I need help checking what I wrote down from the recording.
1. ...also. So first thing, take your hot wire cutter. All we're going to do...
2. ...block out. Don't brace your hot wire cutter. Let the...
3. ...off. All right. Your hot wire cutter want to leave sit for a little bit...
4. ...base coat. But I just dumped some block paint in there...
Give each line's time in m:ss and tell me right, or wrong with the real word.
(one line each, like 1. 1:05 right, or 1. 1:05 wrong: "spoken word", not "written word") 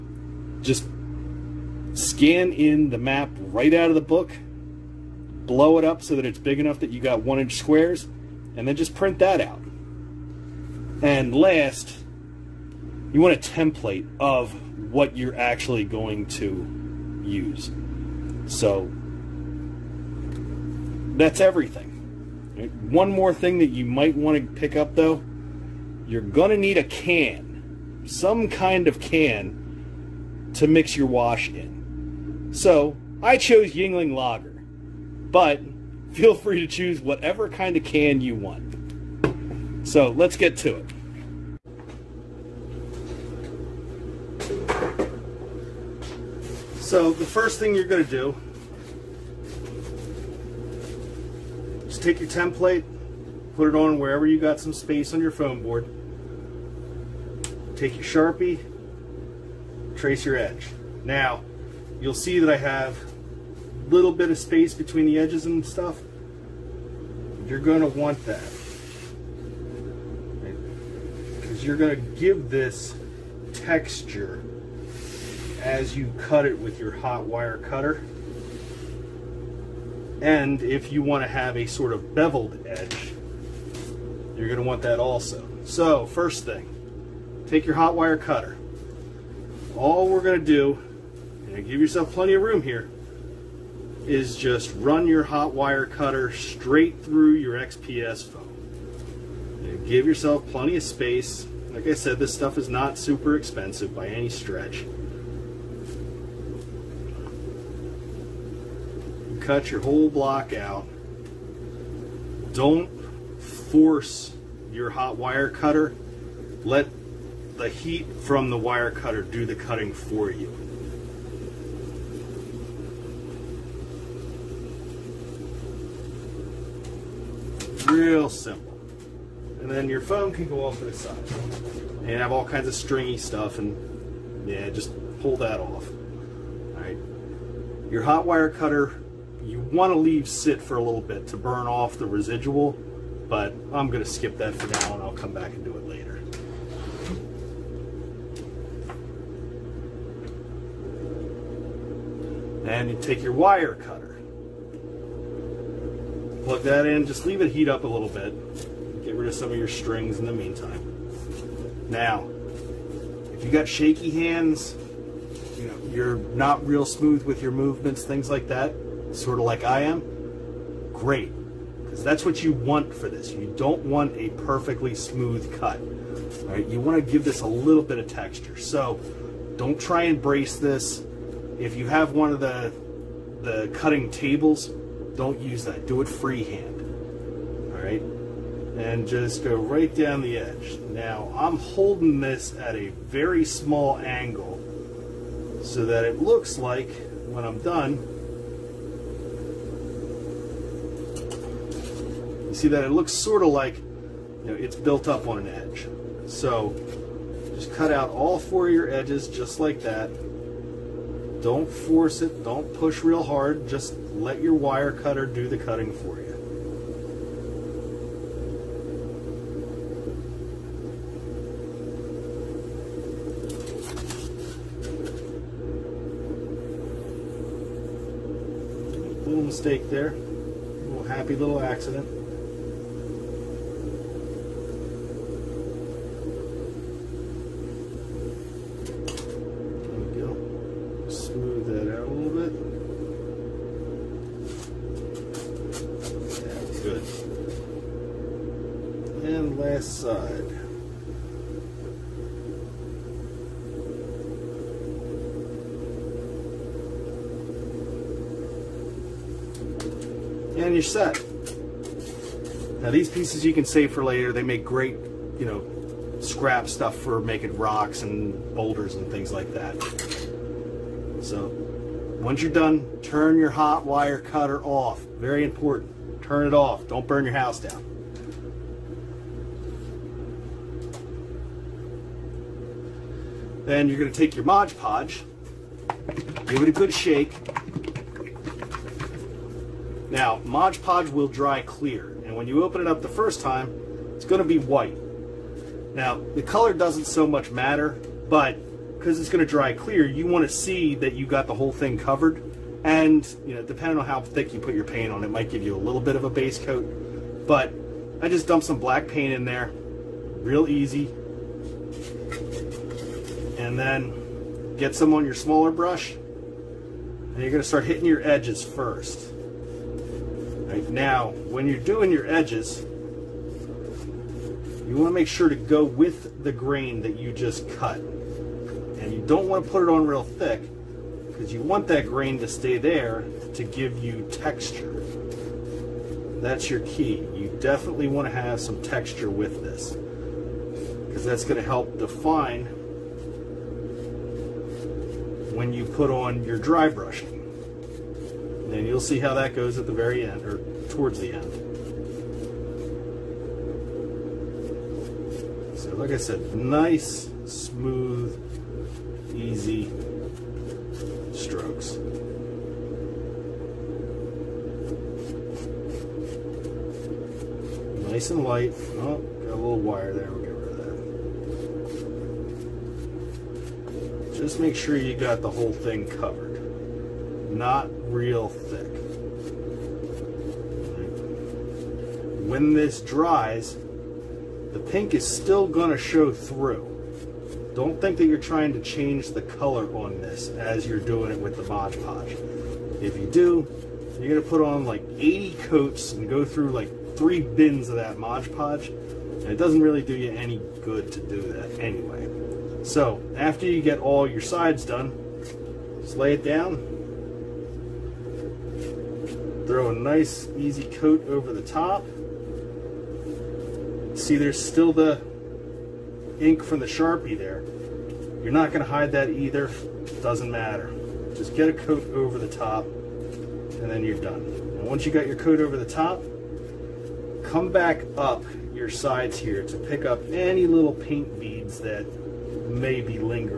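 1. 1:24 right
2. 1:50 wrong: "force", not "brace"
3. 2:15 right
4. 5:06 wrong: "black", not "block".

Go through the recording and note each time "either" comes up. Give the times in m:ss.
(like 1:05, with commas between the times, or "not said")
6:59.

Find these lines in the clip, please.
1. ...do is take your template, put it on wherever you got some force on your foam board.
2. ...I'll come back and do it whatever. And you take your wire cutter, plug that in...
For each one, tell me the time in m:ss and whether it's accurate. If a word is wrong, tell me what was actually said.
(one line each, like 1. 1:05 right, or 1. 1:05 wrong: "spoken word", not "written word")
1. 0:48 wrong: "space", not "force"
2. 2:25 wrong: "later", not "whatever".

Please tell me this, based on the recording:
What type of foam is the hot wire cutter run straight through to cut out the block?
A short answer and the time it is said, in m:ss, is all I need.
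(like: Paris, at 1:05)
XPS foam, at 1:37.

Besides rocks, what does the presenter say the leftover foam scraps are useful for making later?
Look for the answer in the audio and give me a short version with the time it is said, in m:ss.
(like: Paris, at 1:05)
boulders, at 4:28.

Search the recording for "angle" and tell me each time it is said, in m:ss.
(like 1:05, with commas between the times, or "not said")
3:13.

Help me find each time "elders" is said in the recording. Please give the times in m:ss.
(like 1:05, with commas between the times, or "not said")
not said.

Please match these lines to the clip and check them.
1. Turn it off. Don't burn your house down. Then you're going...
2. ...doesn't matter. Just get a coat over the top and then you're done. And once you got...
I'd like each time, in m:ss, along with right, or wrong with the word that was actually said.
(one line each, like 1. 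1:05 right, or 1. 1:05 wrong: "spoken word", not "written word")
1. 4:36 right
2. 7:00 right.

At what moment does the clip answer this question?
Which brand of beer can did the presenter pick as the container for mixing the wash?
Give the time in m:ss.
0:33.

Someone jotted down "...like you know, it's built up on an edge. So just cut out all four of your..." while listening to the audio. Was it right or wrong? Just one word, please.
right.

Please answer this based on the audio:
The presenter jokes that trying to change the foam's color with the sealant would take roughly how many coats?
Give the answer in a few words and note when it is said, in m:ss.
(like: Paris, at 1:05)
80, at 6:35.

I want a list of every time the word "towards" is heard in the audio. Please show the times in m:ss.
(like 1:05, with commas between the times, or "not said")
5:50.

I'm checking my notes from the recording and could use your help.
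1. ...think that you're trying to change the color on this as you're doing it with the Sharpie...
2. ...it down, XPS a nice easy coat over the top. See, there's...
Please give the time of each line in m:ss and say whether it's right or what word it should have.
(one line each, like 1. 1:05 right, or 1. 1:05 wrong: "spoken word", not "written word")
1. 6:27 wrong: "Mod", not "Sharpie"
2. 6:46 wrong: "Throw", not "XPS".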